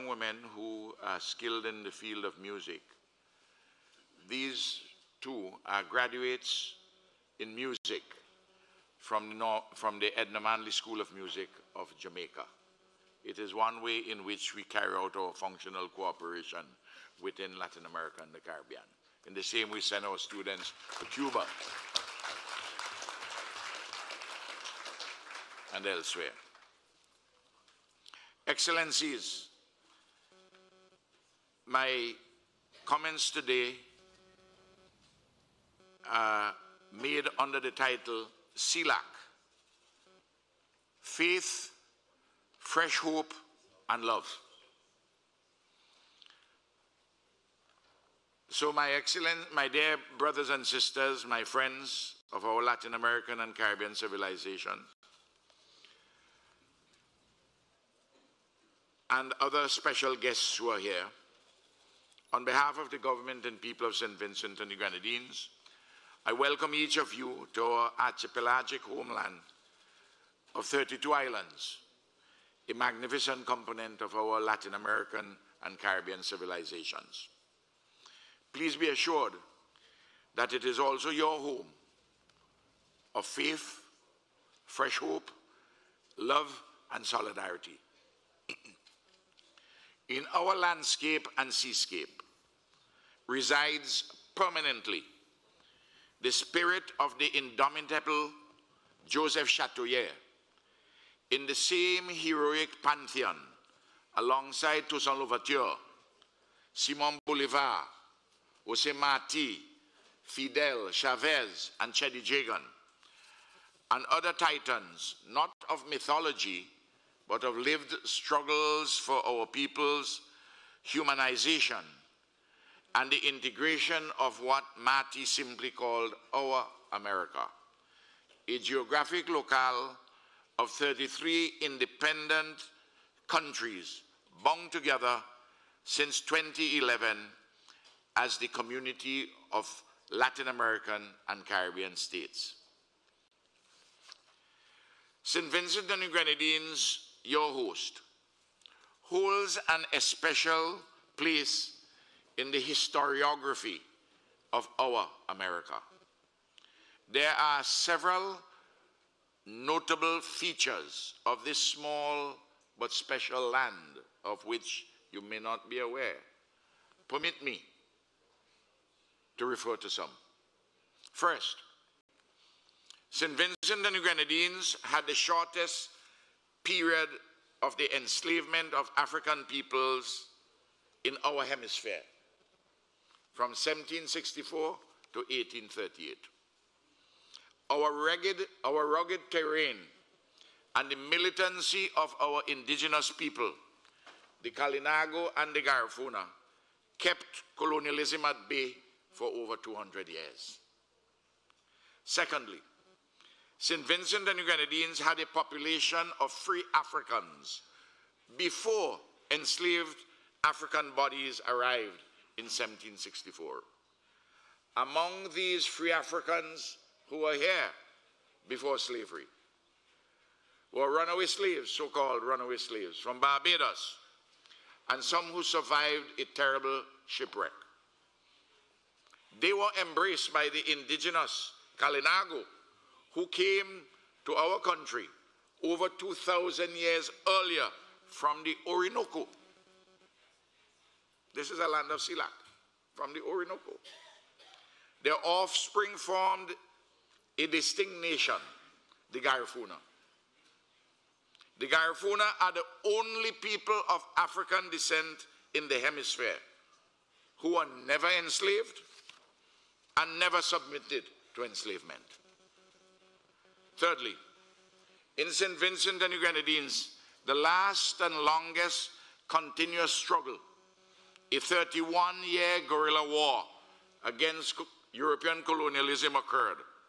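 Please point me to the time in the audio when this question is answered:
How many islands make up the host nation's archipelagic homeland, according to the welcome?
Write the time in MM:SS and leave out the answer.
01:10.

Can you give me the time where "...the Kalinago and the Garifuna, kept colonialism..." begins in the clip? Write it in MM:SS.
03:14.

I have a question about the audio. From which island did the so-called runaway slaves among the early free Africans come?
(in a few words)
Barbados.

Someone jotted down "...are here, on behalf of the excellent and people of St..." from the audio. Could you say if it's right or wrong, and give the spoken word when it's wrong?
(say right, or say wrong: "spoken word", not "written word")
wrong: "government", not "excellent".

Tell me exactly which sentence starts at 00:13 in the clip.
It is one way in which we carry out our functional cooperation within Latin America and the Caribbean.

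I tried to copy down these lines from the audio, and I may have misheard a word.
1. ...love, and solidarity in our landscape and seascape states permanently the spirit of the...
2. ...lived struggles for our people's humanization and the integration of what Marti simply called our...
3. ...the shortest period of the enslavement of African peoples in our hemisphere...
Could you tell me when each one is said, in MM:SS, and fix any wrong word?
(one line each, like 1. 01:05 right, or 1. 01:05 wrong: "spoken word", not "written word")
1. 01:26 wrong: "resides", not "states"
2. 01:57 right
3. 02:55 right.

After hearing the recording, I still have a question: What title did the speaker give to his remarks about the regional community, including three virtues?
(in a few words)
CELAC: Faith, Fresh Hope and Love.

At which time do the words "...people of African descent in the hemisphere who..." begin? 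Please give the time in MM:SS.
04:13.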